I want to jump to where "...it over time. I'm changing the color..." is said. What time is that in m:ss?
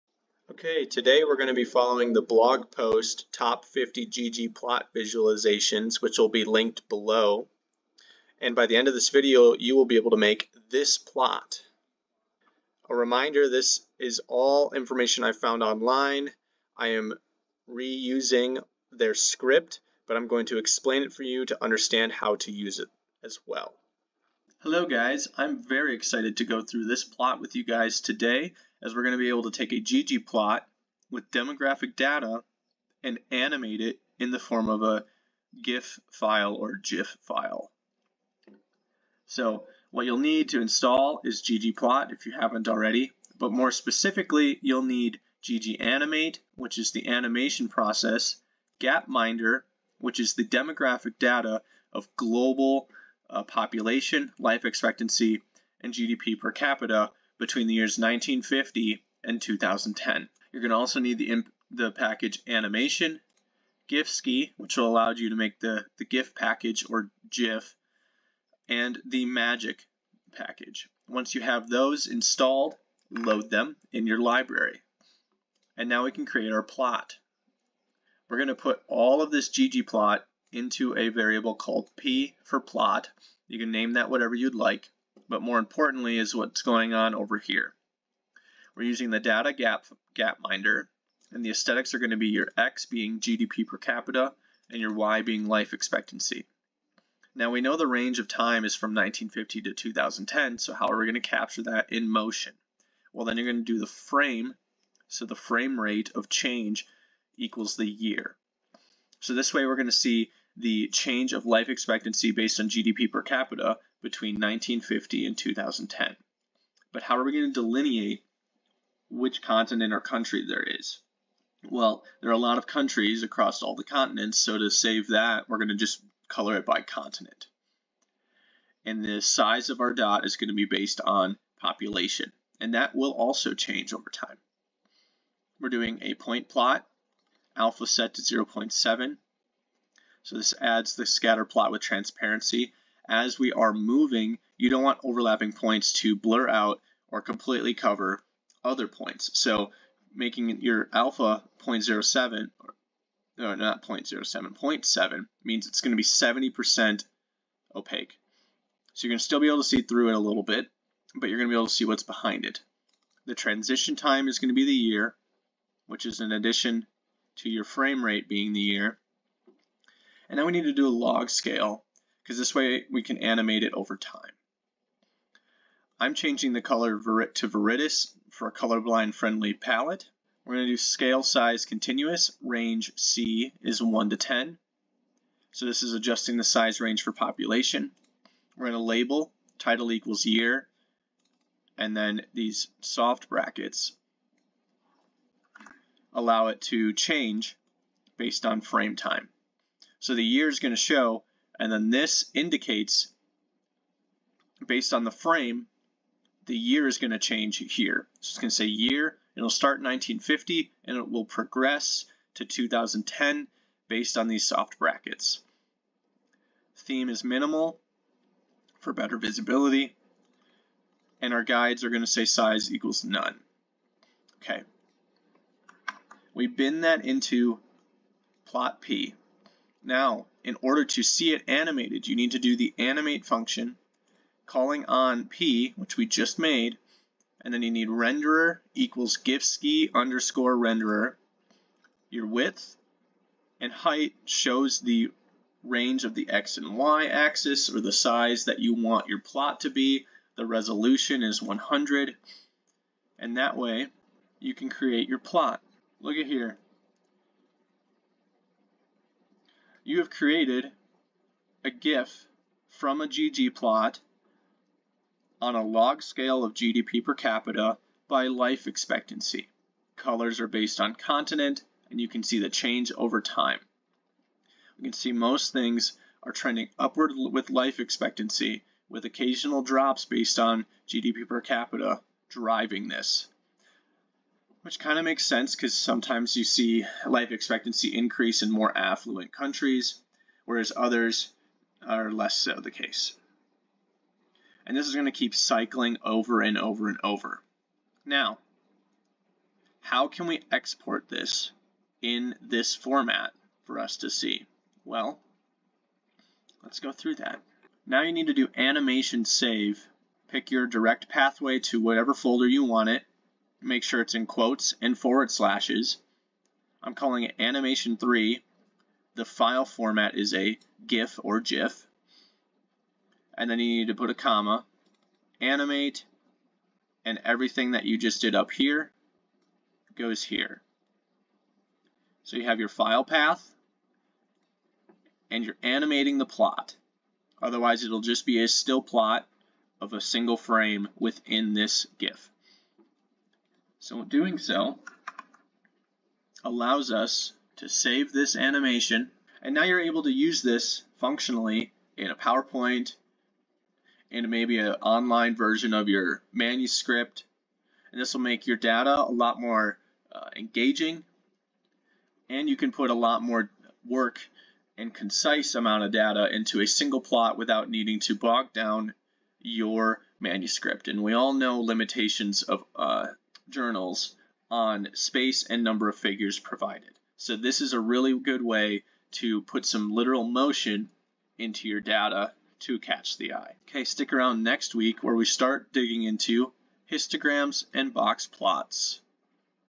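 2:53.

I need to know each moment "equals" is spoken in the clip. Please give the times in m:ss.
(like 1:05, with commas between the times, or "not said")
1:47, 3:09, 3:42, 3:58.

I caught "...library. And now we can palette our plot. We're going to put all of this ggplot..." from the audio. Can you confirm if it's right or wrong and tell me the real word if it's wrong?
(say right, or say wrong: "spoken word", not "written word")
wrong: "create", not "palette".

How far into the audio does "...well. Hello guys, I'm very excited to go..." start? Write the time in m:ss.
0:23.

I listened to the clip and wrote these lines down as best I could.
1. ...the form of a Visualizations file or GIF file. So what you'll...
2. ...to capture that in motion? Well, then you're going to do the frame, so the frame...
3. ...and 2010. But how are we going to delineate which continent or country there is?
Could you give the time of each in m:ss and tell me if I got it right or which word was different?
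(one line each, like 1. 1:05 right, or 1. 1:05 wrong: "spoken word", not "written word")
1. 0:34 wrong: "GIF", not "Visualizations"
2. 1:41 right
3. 1:55 right.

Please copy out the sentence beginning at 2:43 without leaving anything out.
The transition time is going to be the year, which is in addition to your frame rate being the year.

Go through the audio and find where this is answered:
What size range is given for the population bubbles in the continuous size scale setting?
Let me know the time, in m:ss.
3:03.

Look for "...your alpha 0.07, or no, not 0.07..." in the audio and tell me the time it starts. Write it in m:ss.
2:30.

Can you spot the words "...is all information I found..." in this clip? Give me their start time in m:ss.
0:13.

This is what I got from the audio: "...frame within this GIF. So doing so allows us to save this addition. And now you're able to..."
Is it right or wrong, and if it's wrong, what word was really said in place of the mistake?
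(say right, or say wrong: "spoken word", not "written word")
wrong: "animation", not "addition".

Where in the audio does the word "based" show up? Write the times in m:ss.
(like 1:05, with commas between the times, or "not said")
1:52, 2:10, 3:18, 3:24, 3:33, 4:30, 4:40.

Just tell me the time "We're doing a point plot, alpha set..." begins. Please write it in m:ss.
2:15.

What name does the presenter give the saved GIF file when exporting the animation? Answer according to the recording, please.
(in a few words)
animation 3.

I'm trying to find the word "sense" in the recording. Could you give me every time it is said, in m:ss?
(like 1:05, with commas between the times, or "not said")
4:45.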